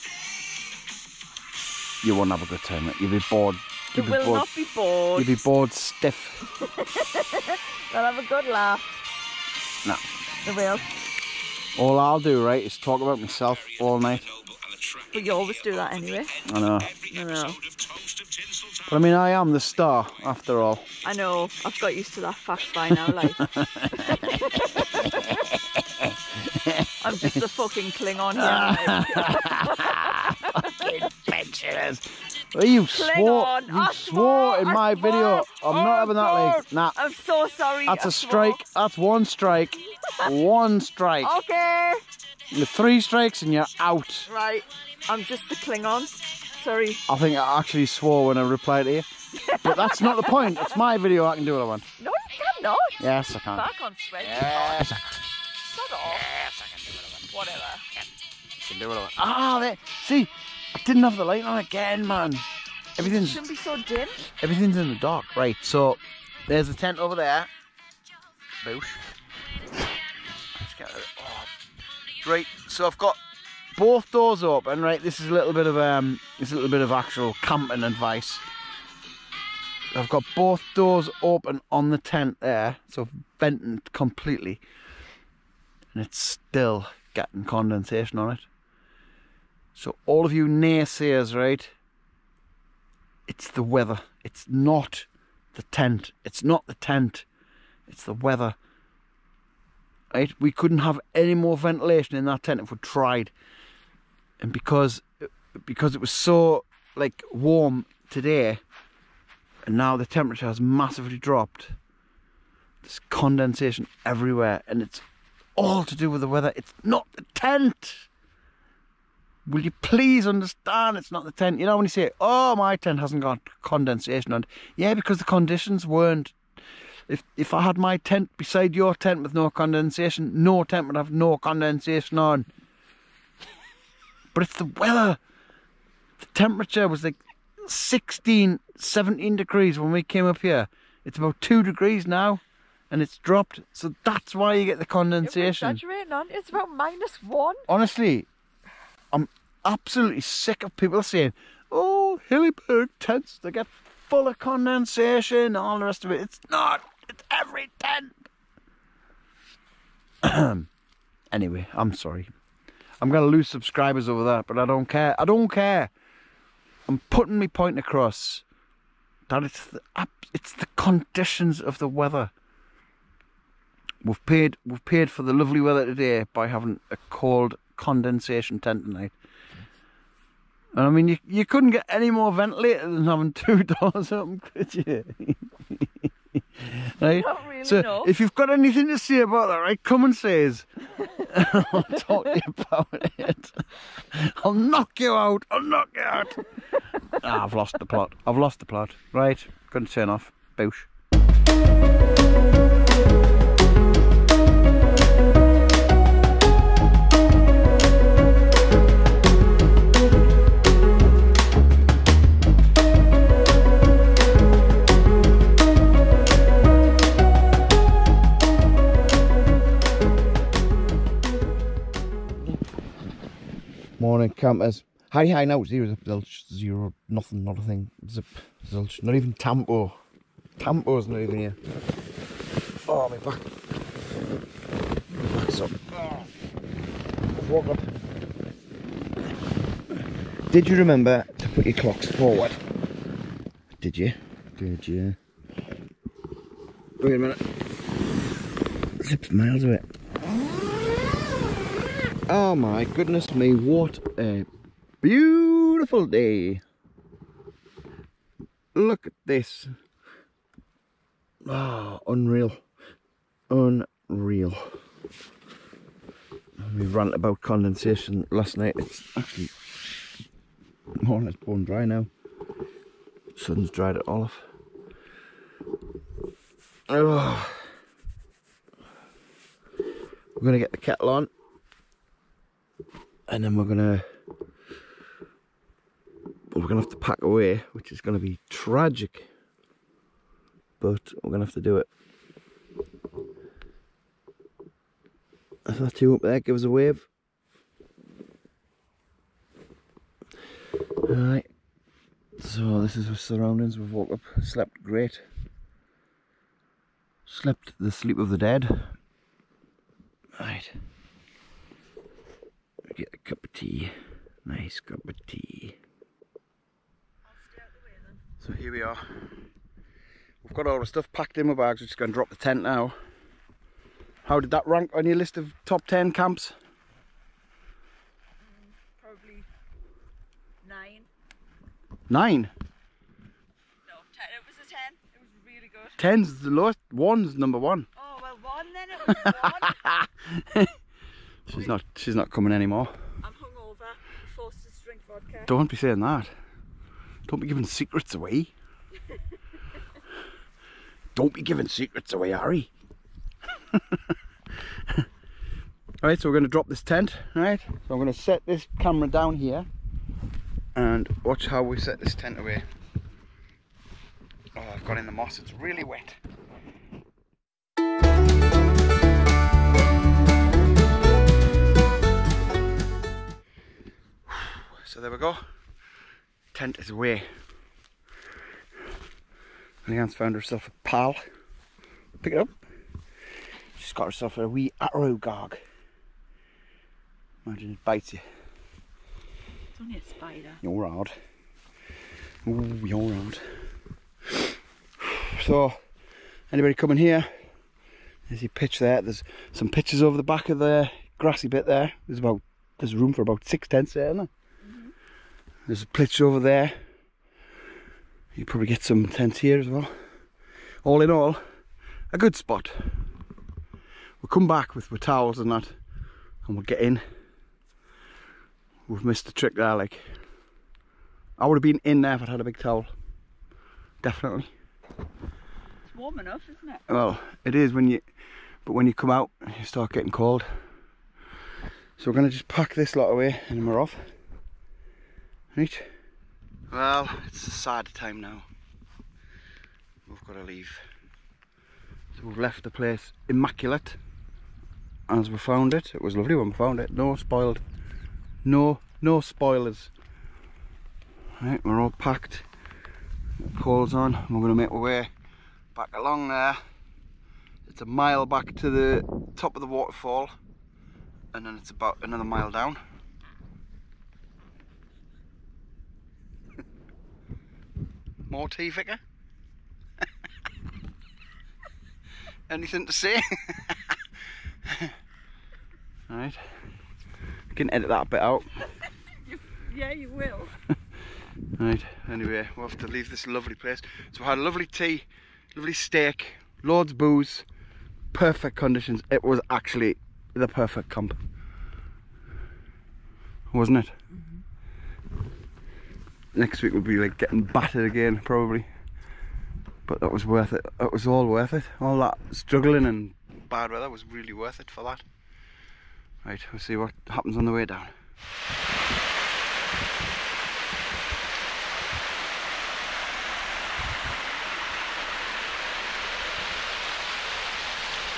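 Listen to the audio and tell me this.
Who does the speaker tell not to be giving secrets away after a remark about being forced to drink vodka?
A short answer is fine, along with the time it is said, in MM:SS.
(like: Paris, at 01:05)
Harry, at 05:52.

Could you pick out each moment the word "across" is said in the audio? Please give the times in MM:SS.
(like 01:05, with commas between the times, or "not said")
02:47.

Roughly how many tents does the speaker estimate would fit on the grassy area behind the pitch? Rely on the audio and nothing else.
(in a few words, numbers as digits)
6.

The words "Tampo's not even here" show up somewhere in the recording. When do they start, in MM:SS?
03:50.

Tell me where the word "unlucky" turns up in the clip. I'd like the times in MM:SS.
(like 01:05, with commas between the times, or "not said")
not said.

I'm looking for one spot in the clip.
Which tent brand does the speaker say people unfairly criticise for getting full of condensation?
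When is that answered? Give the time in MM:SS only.
02:32.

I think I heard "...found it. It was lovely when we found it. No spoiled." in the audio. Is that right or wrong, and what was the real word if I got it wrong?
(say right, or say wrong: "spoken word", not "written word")
right.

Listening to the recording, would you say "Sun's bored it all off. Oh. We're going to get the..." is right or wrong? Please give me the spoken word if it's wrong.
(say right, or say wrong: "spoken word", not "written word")
wrong: "dried", not "bored".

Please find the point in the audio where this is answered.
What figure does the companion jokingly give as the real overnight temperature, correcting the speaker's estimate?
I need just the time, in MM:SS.
02:26.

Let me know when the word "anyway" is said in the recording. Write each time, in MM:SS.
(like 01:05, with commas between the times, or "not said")
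00:15, 02:41, 08:02.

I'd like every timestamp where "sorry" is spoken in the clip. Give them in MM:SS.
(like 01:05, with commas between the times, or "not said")
00:37, 00:46, 02:41.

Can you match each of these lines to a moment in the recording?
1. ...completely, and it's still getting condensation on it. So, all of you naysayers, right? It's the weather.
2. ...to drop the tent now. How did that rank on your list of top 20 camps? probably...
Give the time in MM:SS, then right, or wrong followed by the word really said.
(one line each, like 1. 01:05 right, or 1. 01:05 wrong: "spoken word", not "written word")
1. 01:23 right
2. 05:22 wrong: "10", not "20".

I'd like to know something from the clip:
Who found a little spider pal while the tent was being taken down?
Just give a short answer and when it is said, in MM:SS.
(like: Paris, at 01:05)
Leanne, at 06:19.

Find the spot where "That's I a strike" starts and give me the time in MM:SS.
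00:37.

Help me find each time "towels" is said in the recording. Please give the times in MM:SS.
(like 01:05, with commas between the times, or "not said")
06:54, 07:02.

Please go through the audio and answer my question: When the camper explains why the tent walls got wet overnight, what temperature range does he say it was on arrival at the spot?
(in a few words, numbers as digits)
16, 17 degrees.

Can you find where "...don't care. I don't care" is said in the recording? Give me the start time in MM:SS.
02:44.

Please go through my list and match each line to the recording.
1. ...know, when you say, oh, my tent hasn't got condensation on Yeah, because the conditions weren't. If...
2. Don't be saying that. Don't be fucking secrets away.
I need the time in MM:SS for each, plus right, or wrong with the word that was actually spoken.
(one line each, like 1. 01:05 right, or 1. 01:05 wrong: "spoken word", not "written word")
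1. 02:01 right
2. 05:45 wrong: "giving", not "fucking".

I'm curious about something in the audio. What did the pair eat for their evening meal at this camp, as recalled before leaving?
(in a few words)
steak.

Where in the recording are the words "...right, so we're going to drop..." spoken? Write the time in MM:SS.
05:56.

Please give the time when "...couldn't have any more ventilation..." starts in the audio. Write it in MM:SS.
01:40.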